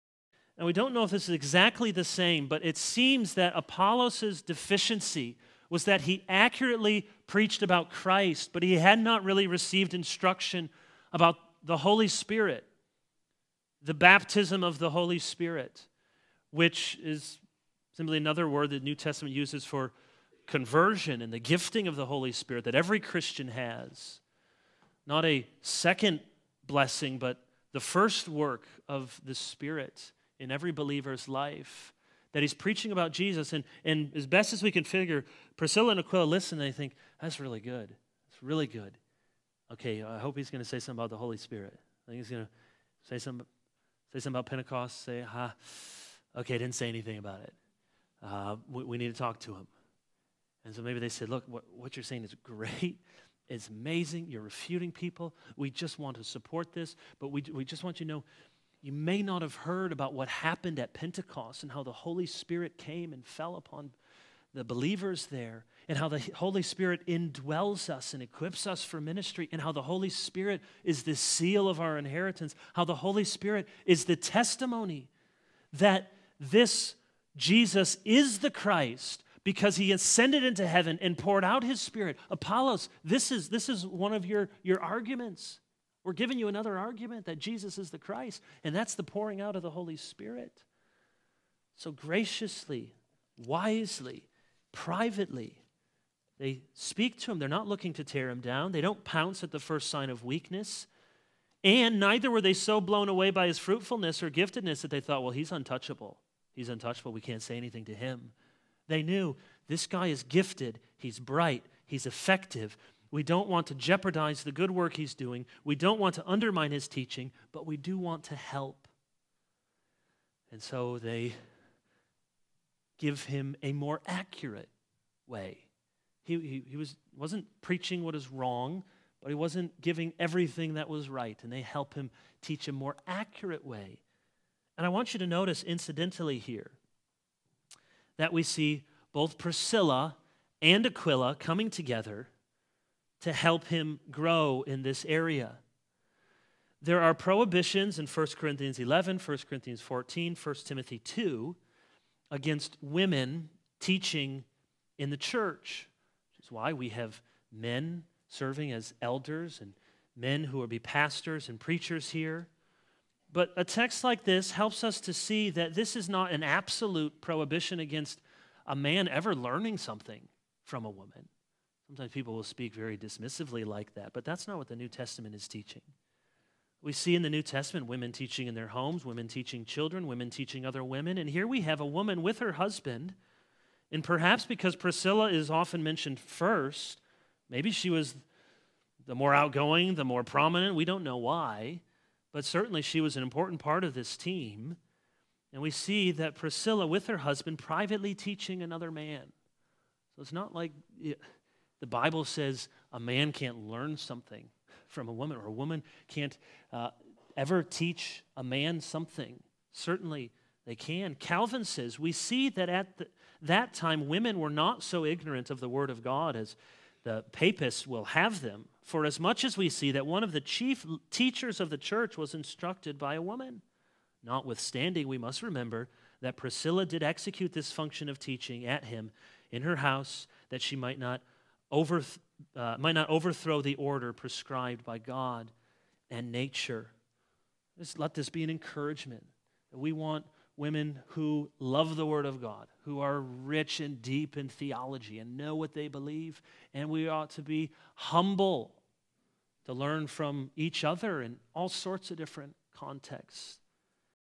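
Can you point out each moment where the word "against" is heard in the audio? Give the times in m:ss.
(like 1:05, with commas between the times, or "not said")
2:32, 2:47.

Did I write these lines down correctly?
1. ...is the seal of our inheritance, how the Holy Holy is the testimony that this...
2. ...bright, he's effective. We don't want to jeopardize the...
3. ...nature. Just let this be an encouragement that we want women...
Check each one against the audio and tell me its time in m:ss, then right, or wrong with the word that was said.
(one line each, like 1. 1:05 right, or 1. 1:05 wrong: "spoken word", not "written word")
1. 1:10 wrong: "Spirit", not "Holy"
2. 1:51 right
3. 3:56 right.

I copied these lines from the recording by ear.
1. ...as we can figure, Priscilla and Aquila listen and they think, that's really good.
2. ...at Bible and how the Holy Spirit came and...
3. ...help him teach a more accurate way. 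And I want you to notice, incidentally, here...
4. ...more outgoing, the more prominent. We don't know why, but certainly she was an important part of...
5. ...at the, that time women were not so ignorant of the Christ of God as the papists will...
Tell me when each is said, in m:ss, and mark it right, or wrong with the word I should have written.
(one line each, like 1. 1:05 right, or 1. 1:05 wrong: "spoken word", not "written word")
1. 0:34 right
2. 1:00 wrong: "Pentecost", not "Bible"
3. 2:11 right
4. 3:09 right
5. 3:32 wrong: "Word", not "Christ".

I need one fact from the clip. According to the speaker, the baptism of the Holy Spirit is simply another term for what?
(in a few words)
Conversion.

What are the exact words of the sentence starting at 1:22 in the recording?
Apollos, this is, this is one of your, your arguments.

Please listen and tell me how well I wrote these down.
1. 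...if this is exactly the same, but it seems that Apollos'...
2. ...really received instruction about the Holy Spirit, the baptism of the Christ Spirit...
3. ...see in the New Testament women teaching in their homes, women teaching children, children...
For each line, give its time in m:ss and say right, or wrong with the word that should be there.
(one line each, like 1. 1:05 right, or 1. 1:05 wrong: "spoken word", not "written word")
1. 0:01 right
2. 0:09 wrong: "Holy", not "Christ"
3. 2:56 wrong: "women", not "children".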